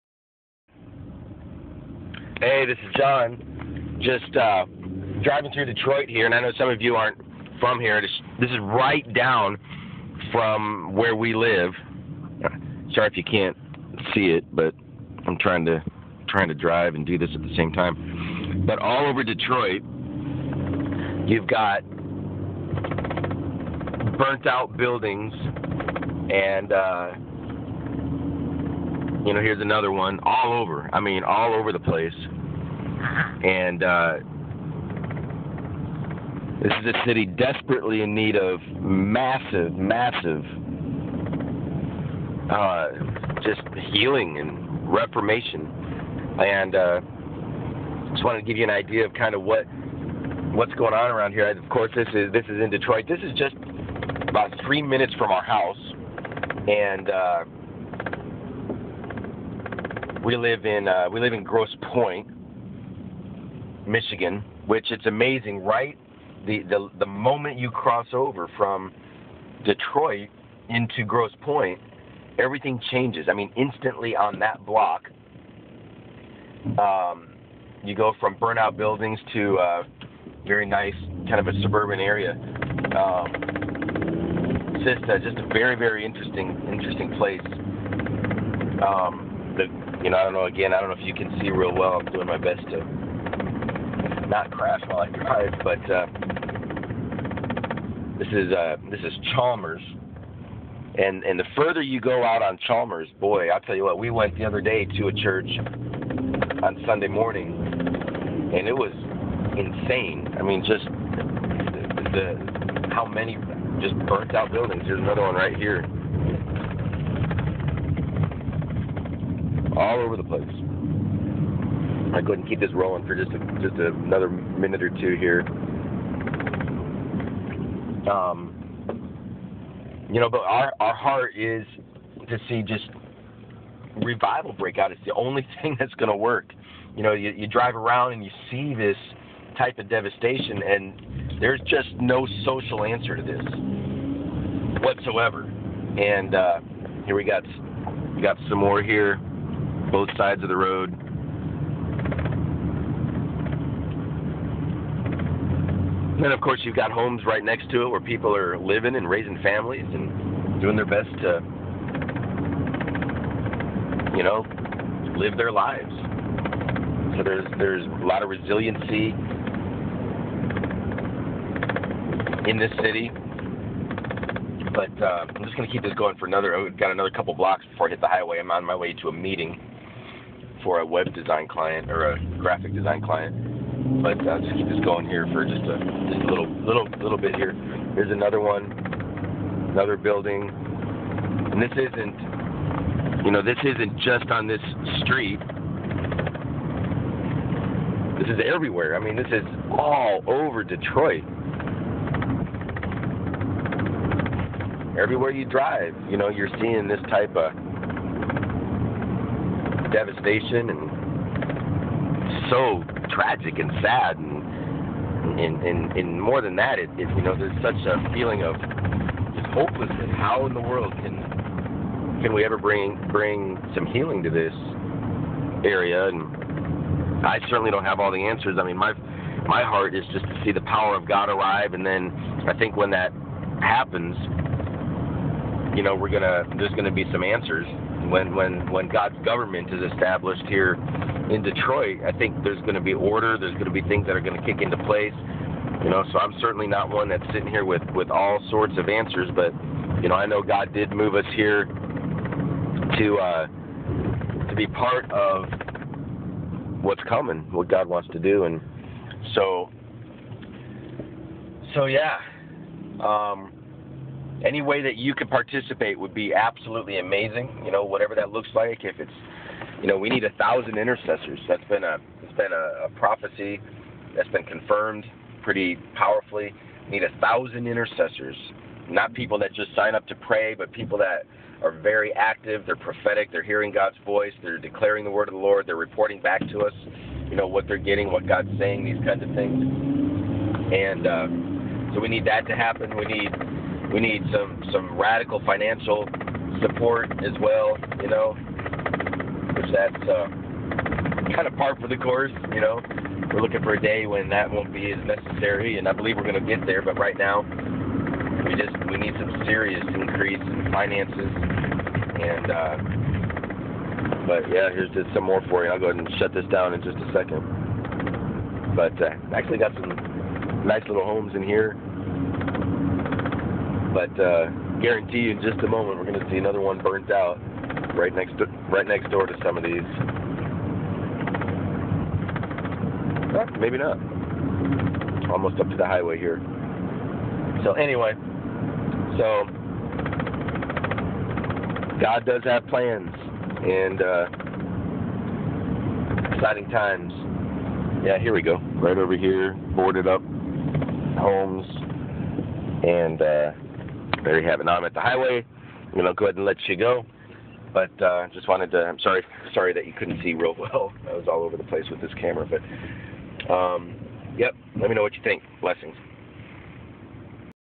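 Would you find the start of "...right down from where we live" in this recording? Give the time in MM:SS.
00:08.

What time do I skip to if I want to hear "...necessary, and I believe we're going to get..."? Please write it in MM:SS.
05:05.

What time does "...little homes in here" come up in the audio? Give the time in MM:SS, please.
05:20.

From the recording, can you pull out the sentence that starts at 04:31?
That's been a it's been a, a prophecy that's been confirmed pretty powerfully.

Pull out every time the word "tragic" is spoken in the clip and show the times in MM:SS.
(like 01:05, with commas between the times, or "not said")
03:33.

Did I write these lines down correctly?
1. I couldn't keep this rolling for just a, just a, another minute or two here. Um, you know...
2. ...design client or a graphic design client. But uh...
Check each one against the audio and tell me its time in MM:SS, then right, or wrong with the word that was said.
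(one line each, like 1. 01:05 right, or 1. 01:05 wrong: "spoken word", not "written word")
1. 02:02 right
2. 03:01 right.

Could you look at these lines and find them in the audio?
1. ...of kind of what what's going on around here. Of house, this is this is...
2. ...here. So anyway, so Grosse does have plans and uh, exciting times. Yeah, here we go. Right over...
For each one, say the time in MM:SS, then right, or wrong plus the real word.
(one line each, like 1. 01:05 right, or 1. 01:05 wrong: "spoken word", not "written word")
1. 00:49 wrong: "course", not "house"
2. 05:36 wrong: "God", not "Grosse".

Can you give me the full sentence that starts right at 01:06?
The, the the moment you cross over from Detroit into Grosse Pointe, everything changes.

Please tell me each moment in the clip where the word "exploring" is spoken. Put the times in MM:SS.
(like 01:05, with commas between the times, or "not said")
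not said.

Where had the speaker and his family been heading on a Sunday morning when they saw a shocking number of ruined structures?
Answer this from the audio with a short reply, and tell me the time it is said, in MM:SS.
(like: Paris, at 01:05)
a church, at 01:45.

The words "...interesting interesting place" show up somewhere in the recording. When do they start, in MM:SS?
01:26.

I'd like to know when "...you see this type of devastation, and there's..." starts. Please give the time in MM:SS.
02:18.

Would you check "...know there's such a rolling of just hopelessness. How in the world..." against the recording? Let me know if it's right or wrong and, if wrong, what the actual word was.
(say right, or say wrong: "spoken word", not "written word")
wrong: "feeling", not "rolling".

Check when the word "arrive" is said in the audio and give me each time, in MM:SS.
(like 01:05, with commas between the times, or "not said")
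03:51.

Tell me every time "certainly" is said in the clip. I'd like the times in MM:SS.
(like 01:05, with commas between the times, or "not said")
03:47, 04:06.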